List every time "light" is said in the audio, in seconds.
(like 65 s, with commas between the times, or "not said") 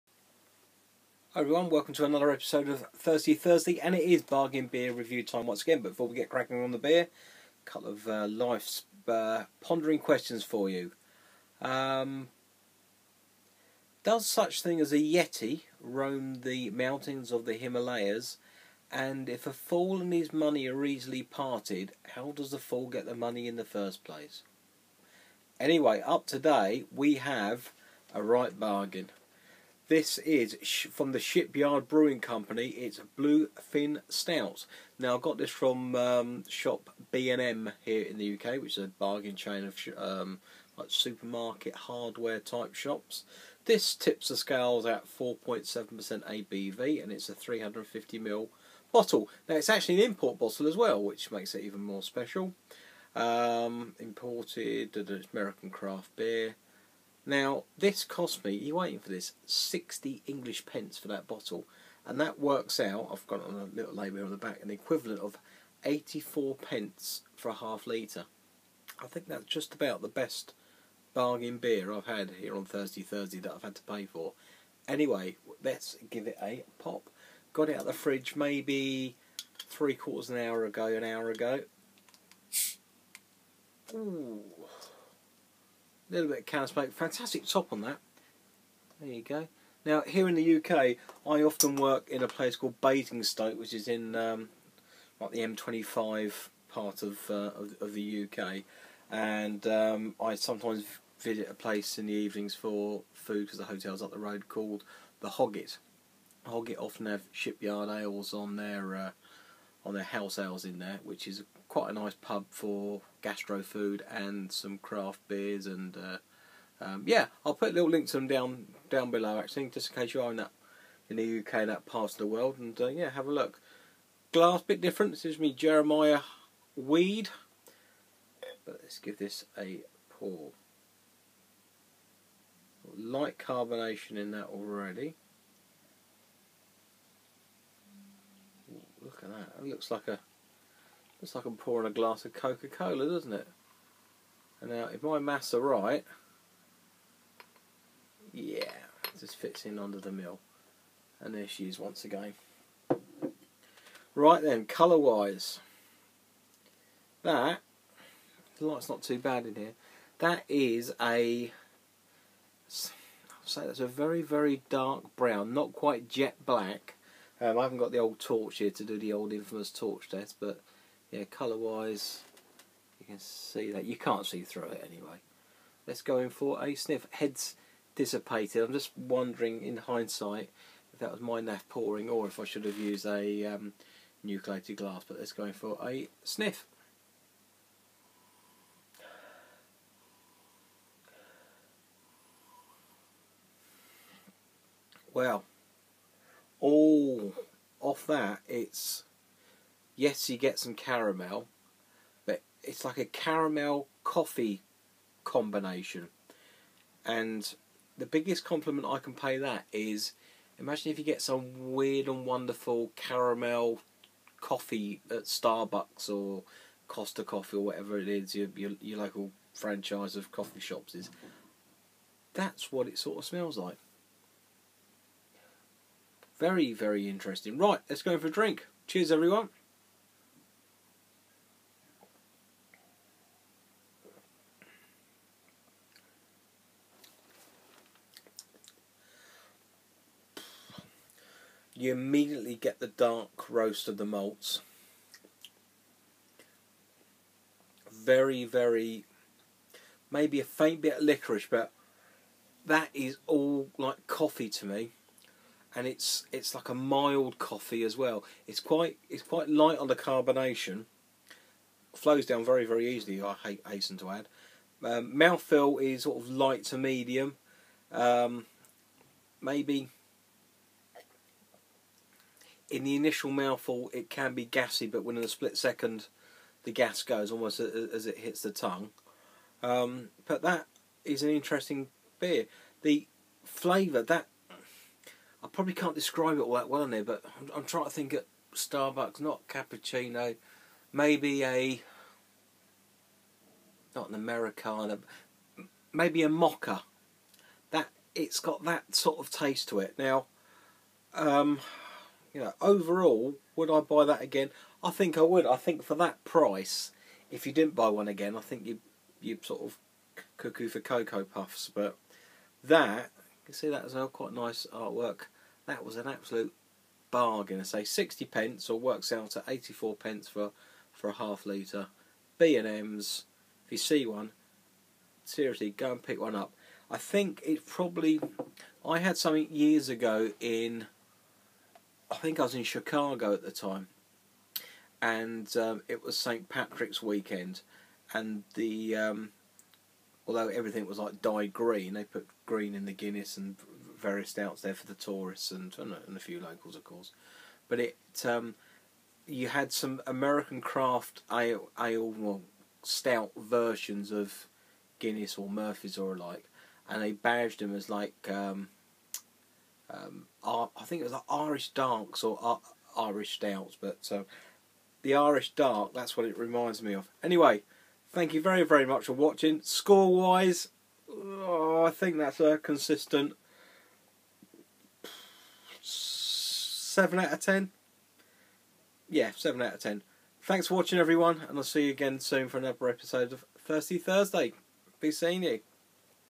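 132 s, 158 s, 259 s, 266 s.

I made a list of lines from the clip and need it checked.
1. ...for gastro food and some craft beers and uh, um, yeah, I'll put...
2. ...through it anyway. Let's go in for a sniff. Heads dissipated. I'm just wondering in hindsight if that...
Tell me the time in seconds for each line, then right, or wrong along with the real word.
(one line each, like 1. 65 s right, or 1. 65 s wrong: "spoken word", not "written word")
1. 112 s right
2. 174 s right.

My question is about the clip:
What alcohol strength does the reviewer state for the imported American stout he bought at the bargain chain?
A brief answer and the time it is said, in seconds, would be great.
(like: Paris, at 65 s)
4.7%, at 45 s.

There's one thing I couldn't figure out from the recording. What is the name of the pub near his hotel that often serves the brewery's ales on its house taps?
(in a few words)
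The Hogget.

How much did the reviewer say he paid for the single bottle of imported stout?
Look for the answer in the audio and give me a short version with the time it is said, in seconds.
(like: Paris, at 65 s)
60 pence, at 59 s.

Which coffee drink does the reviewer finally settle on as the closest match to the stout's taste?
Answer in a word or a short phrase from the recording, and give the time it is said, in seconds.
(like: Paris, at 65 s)
Mocha, at 296 s.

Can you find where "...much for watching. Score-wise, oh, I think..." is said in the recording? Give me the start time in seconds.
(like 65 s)
368 s.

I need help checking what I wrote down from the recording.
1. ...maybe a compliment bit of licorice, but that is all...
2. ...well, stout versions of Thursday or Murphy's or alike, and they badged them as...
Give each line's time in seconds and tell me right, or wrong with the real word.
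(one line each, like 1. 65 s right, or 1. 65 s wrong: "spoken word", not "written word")
1. 250 s wrong: "faint", not "compliment"
2. 352 s wrong: "Guinness", not "Thursday".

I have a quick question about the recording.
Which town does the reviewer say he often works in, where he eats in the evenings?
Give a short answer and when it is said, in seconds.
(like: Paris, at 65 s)
Basingstoke, at 92 s.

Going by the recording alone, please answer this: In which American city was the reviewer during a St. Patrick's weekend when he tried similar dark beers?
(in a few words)
Chicago.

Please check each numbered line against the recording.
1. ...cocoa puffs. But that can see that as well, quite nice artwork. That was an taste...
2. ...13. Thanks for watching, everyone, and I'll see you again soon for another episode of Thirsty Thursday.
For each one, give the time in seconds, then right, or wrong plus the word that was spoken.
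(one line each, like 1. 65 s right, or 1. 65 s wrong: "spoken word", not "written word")
1. 310 s wrong: "absolute", not "taste"
2. 379 s wrong: "10", not "13".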